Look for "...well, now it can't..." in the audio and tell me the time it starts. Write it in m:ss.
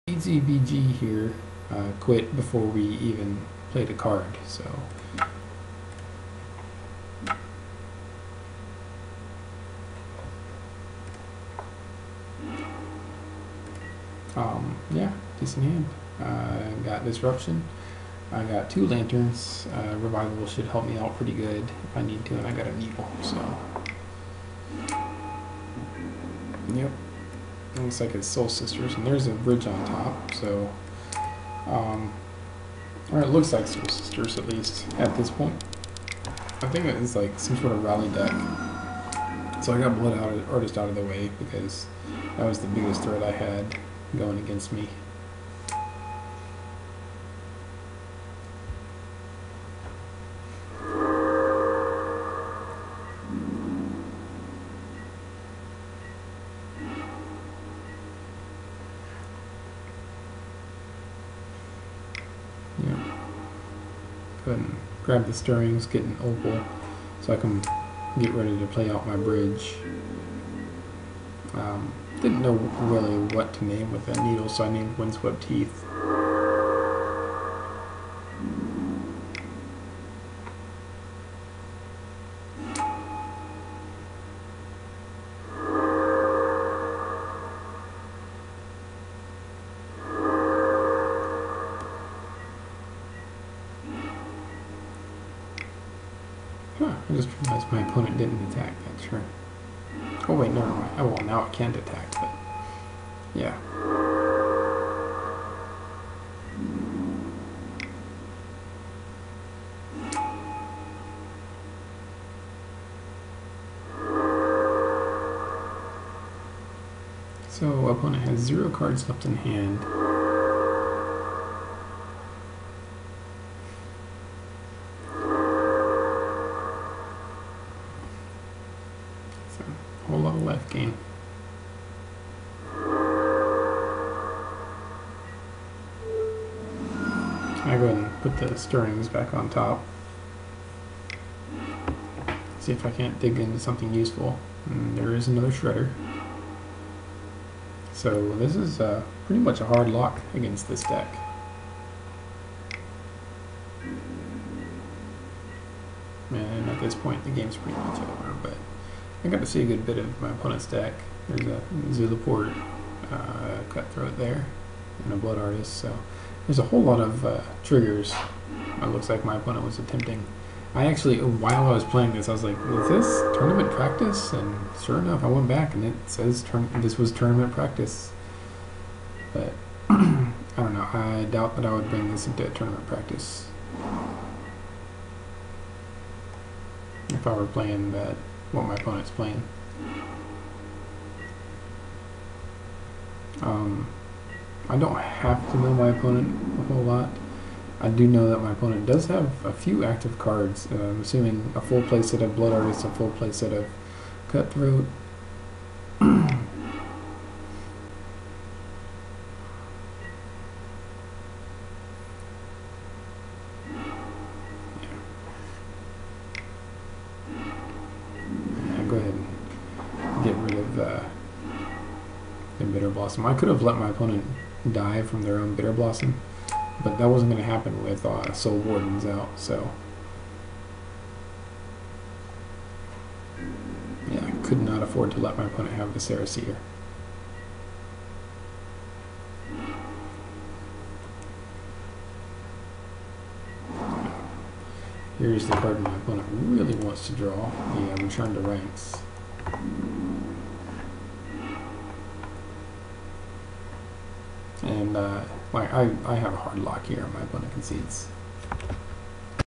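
1:41.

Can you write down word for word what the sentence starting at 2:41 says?
There's a Zulaport uh, Cutthroat there, and a Blood Artist, so there's a whole lot of uh, triggers.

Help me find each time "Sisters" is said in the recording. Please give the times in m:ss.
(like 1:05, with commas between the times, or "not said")
0:28, 0:33.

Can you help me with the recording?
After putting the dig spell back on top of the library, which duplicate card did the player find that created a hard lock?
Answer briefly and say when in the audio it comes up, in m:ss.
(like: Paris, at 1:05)
shredder, at 2:25.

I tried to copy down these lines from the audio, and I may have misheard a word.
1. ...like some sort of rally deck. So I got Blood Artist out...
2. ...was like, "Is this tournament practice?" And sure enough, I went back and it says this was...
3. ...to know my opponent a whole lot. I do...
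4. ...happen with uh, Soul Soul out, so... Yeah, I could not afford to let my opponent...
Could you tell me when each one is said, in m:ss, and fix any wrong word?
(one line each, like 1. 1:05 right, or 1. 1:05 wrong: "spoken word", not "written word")
1. 0:37 right
2. 2:52 right
3. 3:15 right
4. 3:47 wrong: "Wardens", not "Soul".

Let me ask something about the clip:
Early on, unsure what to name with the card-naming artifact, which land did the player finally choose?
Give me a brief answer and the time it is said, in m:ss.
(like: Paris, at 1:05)
Windswept Heath, at 1:14.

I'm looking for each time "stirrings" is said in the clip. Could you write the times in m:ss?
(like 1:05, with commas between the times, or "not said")
1:05, 2:18.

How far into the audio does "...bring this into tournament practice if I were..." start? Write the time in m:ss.
3:01.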